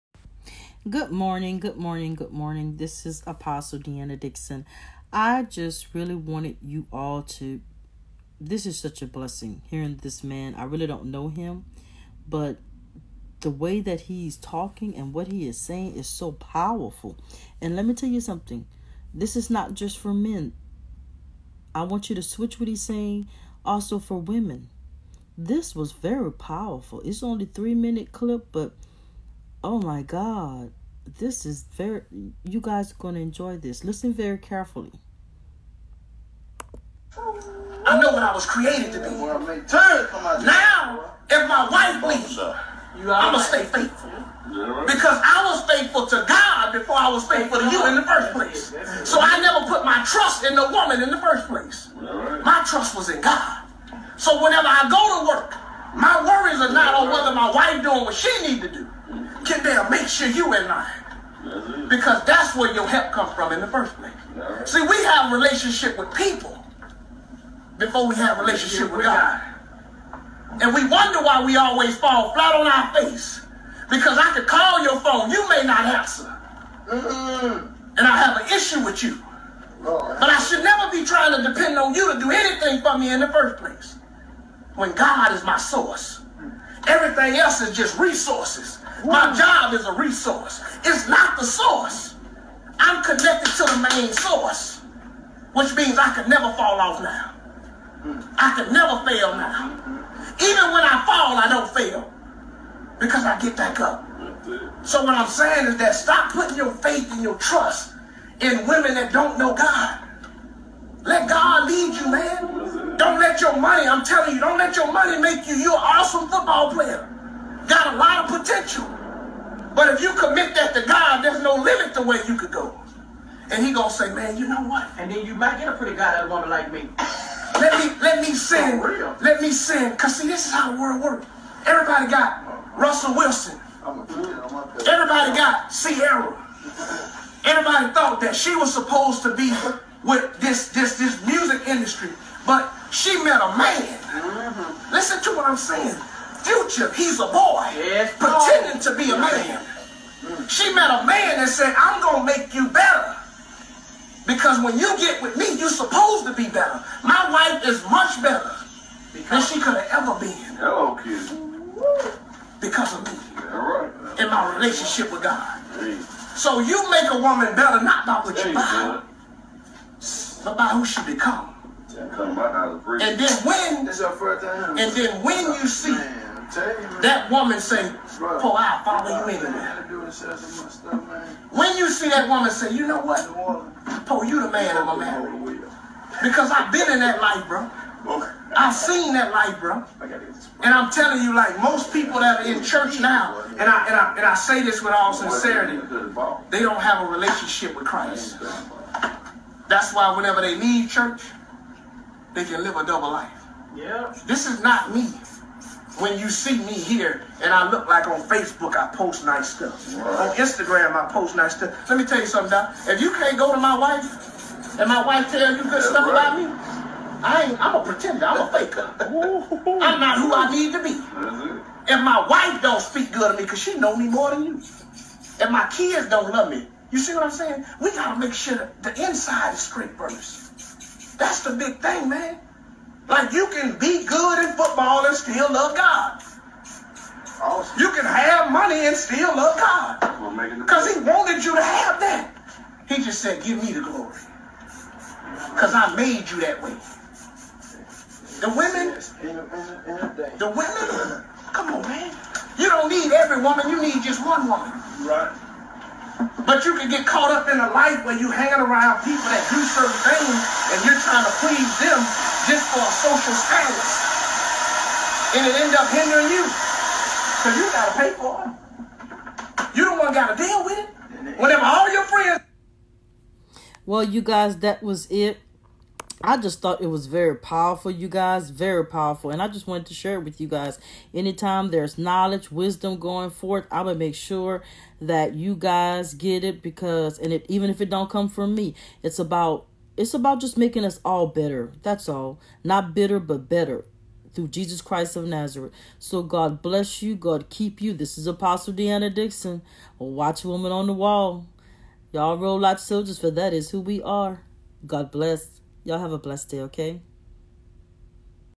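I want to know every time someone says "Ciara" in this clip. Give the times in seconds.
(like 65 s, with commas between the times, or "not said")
135 s.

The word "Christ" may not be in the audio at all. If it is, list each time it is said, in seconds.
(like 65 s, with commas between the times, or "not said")
197 s, 294 s.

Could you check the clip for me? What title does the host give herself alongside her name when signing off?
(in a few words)
Watch Woman on the wall.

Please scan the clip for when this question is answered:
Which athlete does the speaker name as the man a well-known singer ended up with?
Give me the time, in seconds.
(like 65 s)
132 s.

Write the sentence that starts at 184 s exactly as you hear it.
Paul, you the man I'm man, because I've been in that life, bro.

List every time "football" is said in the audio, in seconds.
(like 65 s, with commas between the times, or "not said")
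116 s, 234 s.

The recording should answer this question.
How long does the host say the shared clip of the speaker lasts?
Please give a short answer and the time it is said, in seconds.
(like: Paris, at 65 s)
3 minutes, at 27 s.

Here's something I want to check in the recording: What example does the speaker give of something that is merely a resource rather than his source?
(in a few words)
My job.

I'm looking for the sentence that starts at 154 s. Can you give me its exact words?
Because when you get with me, you're supposed to be better.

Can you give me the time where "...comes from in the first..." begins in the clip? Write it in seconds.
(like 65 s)
63 s.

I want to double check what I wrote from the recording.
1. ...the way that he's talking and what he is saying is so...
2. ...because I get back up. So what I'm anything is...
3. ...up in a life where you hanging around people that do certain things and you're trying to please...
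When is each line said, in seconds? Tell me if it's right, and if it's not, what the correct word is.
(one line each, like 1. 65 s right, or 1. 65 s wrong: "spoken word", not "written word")
1. 13 s right
2. 102 s wrong: "saying", not "anything"
3. 257 s right.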